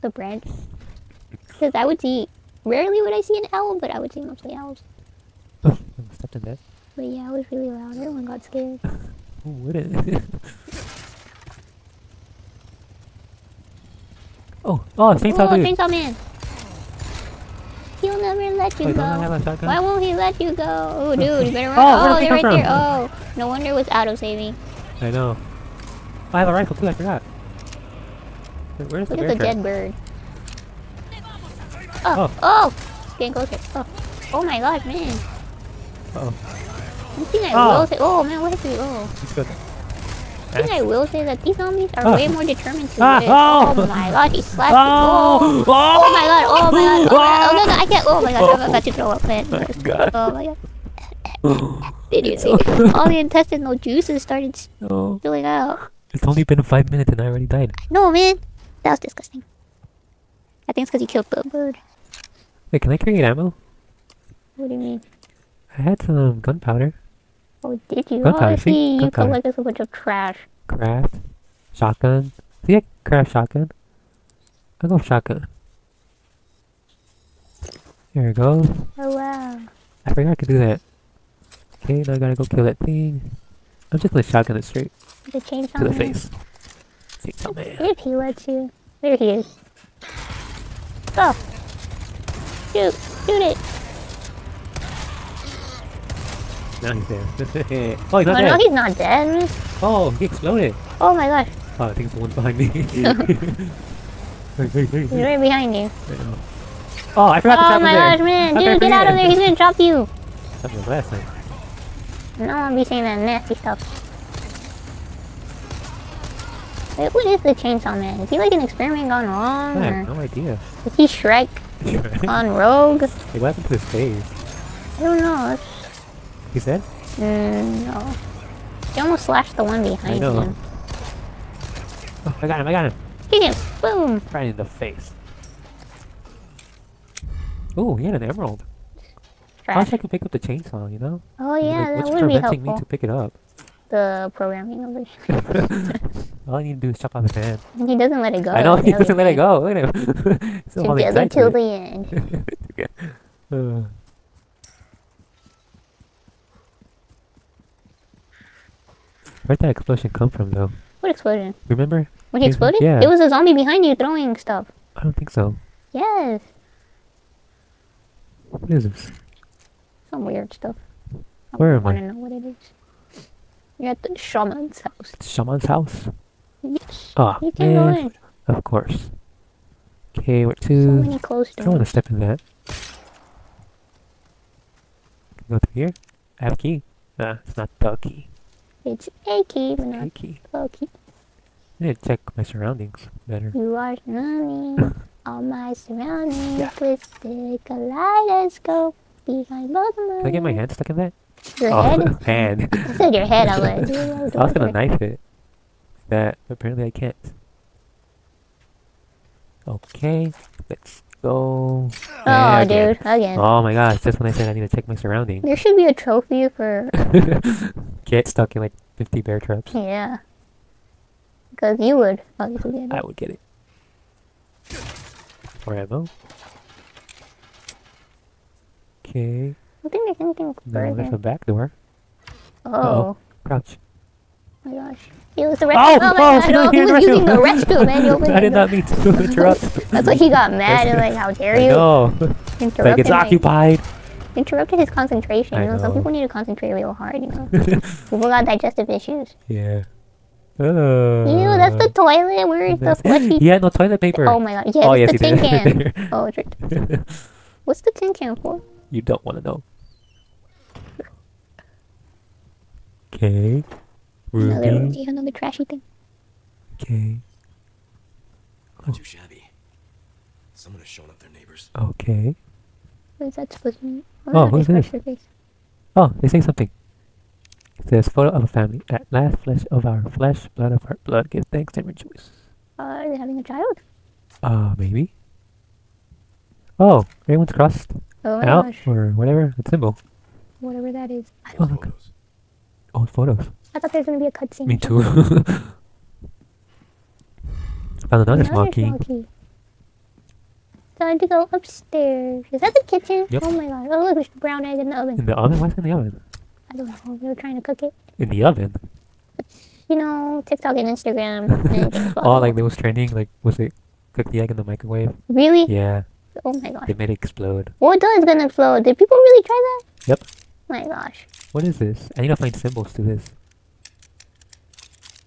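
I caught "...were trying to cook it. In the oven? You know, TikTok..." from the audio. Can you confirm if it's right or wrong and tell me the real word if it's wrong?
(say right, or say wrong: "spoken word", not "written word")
right.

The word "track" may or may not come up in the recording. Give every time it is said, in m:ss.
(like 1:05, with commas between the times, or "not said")
0:29.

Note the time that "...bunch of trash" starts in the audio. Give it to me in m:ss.
1:09.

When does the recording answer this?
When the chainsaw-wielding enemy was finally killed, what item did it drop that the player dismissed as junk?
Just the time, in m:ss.
2:17.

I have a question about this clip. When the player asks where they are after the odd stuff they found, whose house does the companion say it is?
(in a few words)
The shaman's house.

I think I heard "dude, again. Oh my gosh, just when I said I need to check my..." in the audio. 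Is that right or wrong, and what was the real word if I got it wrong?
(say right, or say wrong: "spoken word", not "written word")
right.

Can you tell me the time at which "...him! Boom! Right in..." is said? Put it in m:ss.
2:13.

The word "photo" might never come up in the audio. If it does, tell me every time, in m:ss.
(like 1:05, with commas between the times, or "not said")
4:38, 4:53.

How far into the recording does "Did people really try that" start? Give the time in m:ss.
5:18.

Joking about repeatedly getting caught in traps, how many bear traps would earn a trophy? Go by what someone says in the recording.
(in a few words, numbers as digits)
50.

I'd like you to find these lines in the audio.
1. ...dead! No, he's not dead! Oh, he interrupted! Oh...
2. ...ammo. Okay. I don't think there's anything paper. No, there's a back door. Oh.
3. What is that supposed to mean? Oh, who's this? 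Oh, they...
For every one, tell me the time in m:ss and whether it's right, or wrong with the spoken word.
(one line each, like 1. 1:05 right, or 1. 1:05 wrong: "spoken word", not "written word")
1. 1:38 wrong: "exploded", not "interrupted"
2. 3:45 wrong: "further", not "paper"
3. 4:33 right.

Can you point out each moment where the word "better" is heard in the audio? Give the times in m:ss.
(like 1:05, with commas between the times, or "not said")
0:21, 3:13.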